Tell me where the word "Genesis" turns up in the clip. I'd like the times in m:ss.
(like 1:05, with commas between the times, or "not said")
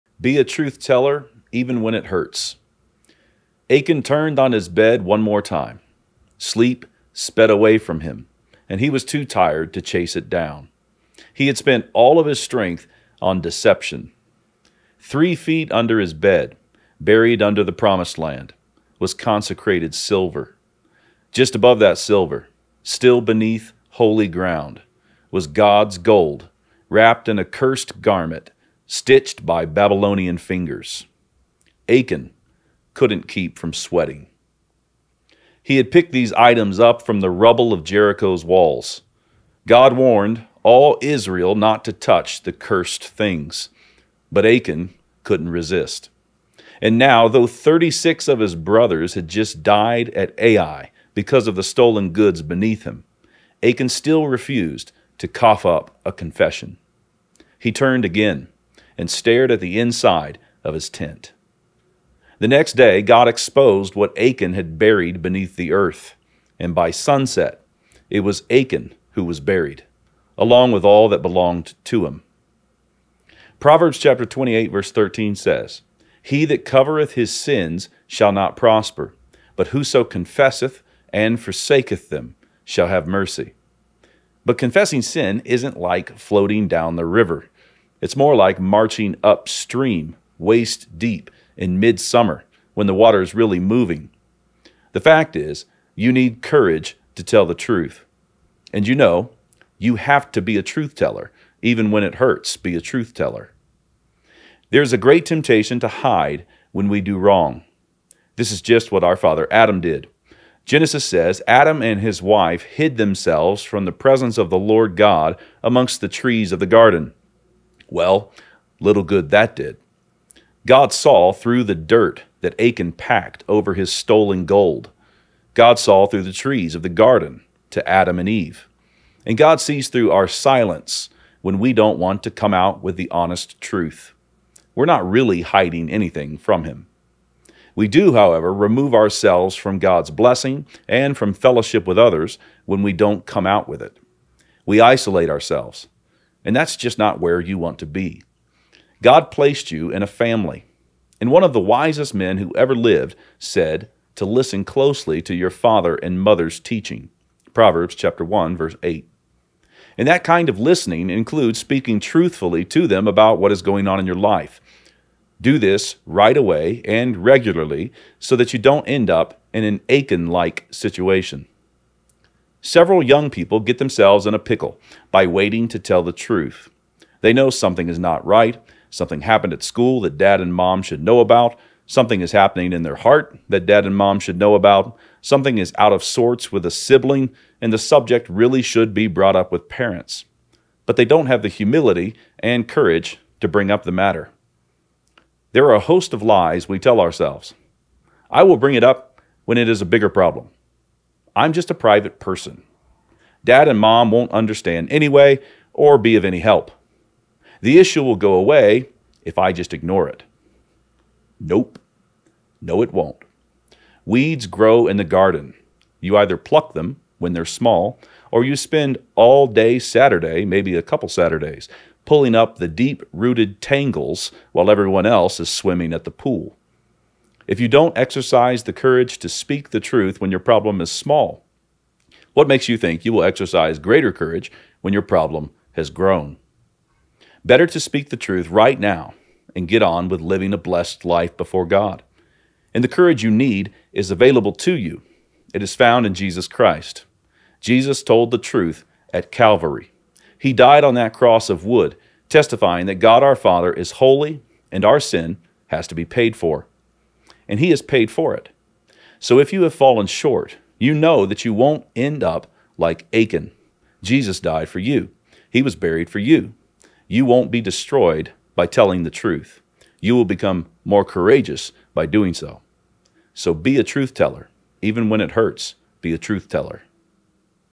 1:50.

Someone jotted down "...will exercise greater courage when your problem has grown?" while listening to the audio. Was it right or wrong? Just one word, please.
right.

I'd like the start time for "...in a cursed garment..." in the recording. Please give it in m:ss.
0:27.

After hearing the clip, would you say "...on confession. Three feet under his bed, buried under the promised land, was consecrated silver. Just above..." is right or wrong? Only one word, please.
wrong.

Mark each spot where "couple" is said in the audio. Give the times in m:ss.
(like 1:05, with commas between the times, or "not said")
3:40.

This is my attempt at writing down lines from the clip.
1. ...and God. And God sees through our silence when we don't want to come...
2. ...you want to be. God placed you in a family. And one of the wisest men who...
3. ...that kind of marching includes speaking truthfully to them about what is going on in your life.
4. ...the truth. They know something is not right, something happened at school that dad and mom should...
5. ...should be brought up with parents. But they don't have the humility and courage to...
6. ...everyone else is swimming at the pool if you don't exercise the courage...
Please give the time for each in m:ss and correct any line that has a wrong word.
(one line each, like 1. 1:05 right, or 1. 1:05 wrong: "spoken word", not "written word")
1. 2:08 wrong: "Eve", not "God"
2. 2:27 right
3. 2:40 wrong: "listening", not "marching"
4. 2:56 right
5. 3:08 right
6. 3:44 right.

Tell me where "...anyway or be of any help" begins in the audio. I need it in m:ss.
3:24.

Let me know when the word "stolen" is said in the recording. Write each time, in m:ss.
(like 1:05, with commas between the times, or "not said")
0:51, 2:03.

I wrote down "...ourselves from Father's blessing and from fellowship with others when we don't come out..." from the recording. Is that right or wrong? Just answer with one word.
wrong.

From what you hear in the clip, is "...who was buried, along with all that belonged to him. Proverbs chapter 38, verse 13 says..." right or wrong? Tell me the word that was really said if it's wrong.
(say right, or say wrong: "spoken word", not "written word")
wrong: "28", not "38".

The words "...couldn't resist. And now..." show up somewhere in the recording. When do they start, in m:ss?
0:45.